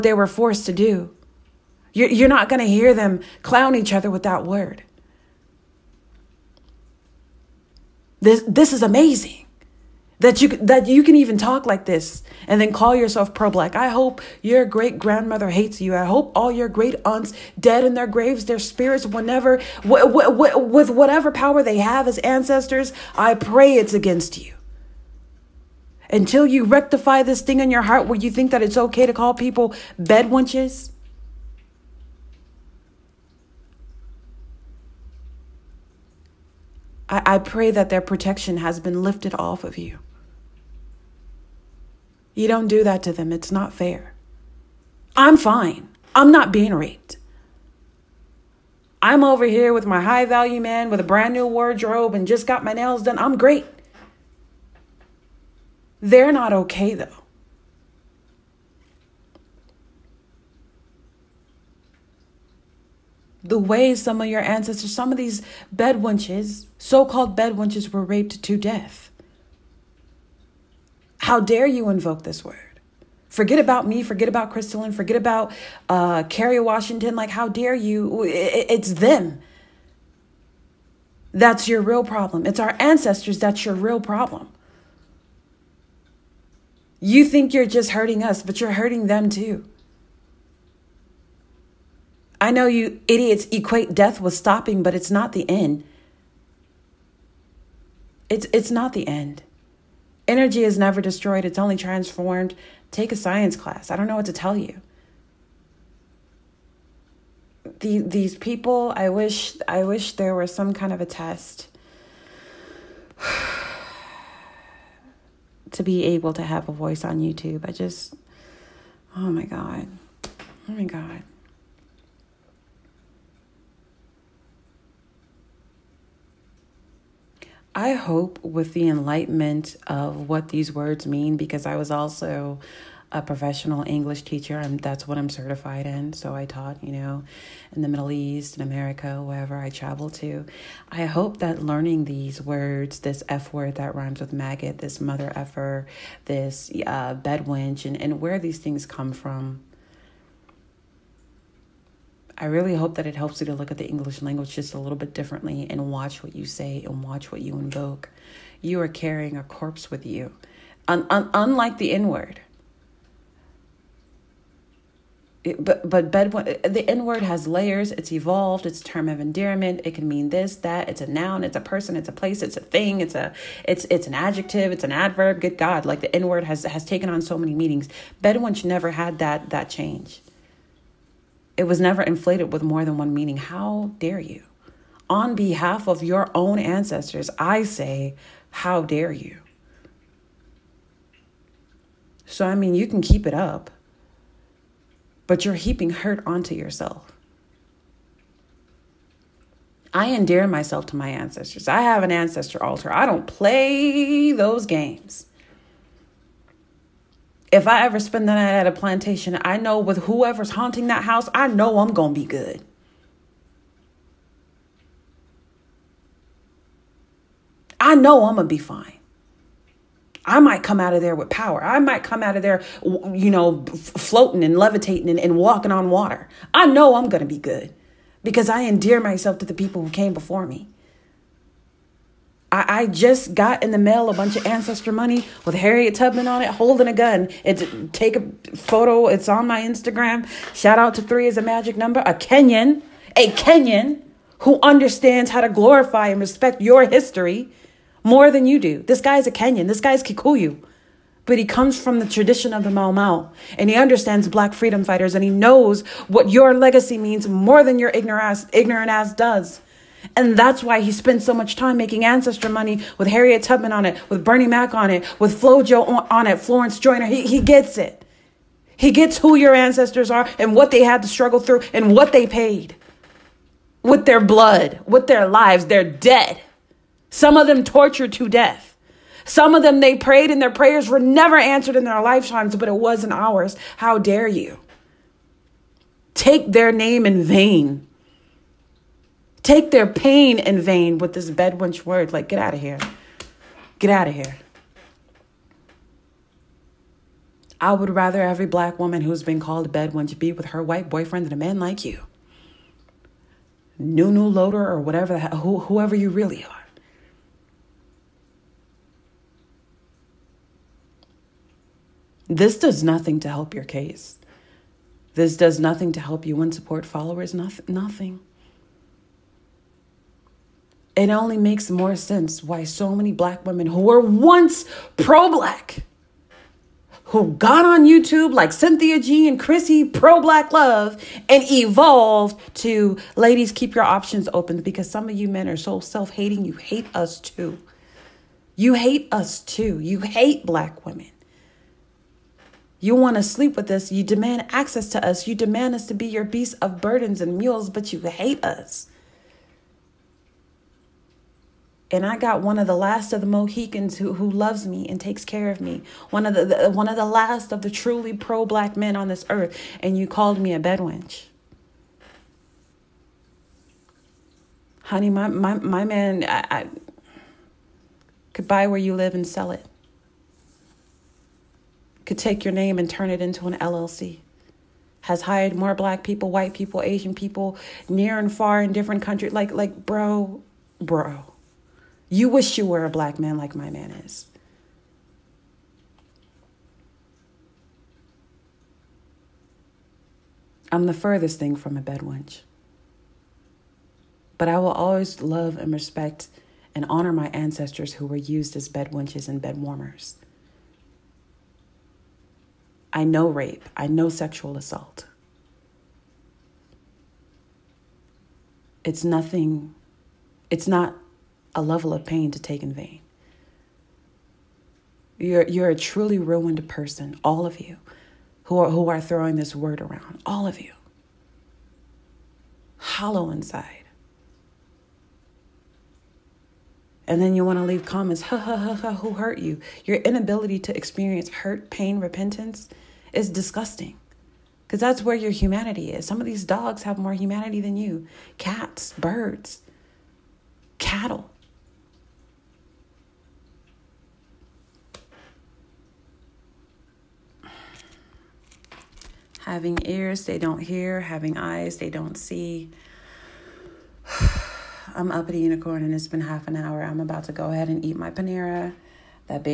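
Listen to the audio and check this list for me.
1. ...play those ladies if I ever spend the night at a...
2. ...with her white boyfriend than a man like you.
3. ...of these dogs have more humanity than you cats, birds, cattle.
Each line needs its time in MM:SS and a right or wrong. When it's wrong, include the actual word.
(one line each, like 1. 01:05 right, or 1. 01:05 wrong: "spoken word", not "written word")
1. 03:23 wrong: "games", not "ladies"
2. 05:00 right
3. 07:16 right.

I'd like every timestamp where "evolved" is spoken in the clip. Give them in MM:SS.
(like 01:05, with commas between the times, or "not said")
02:48, 05:31.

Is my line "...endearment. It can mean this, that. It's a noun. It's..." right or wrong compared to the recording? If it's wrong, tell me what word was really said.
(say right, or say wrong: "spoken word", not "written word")
right.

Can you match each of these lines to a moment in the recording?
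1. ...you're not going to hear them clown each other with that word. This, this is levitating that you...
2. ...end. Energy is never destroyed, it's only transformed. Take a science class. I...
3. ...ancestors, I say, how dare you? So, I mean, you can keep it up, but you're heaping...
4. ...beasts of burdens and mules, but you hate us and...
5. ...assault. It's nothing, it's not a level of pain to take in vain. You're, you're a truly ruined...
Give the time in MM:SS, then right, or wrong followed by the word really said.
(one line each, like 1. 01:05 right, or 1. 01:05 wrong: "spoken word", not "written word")
1. 00:02 wrong: "amazing", not "levitating"
2. 01:39 right
3. 03:06 right
4. 05:46 right
5. 06:44 right.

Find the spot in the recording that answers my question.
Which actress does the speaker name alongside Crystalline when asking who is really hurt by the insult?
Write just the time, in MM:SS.
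01:16.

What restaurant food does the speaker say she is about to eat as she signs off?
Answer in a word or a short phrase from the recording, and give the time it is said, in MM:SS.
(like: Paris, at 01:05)
Panera, at 07:38.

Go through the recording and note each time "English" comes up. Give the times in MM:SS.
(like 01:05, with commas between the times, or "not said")
02:13, 02:33.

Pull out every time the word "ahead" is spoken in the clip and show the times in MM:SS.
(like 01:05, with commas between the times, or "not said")
07:37.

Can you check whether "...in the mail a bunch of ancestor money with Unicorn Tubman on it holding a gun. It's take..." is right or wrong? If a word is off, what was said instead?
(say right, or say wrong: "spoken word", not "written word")
wrong: "Harriet", not "Unicorn".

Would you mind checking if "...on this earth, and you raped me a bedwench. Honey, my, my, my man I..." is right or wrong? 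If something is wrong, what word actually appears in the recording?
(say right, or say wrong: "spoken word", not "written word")
wrong: "called", not "raped".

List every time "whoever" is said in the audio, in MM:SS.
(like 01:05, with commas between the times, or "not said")
03:30, 05:05.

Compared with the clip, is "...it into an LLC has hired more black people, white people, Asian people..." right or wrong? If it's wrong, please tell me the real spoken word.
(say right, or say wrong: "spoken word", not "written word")
right.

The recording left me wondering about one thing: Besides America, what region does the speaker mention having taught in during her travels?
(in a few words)
the Middle East.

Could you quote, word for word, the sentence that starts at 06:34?
But I will always love and respect and honor my ancestors who were used as bedwenches and bedwarmers.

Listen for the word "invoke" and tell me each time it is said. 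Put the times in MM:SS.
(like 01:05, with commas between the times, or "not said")
01:11, 02:37.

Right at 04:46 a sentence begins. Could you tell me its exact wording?
Take their name in vain take their pain in vain with this bedwench word.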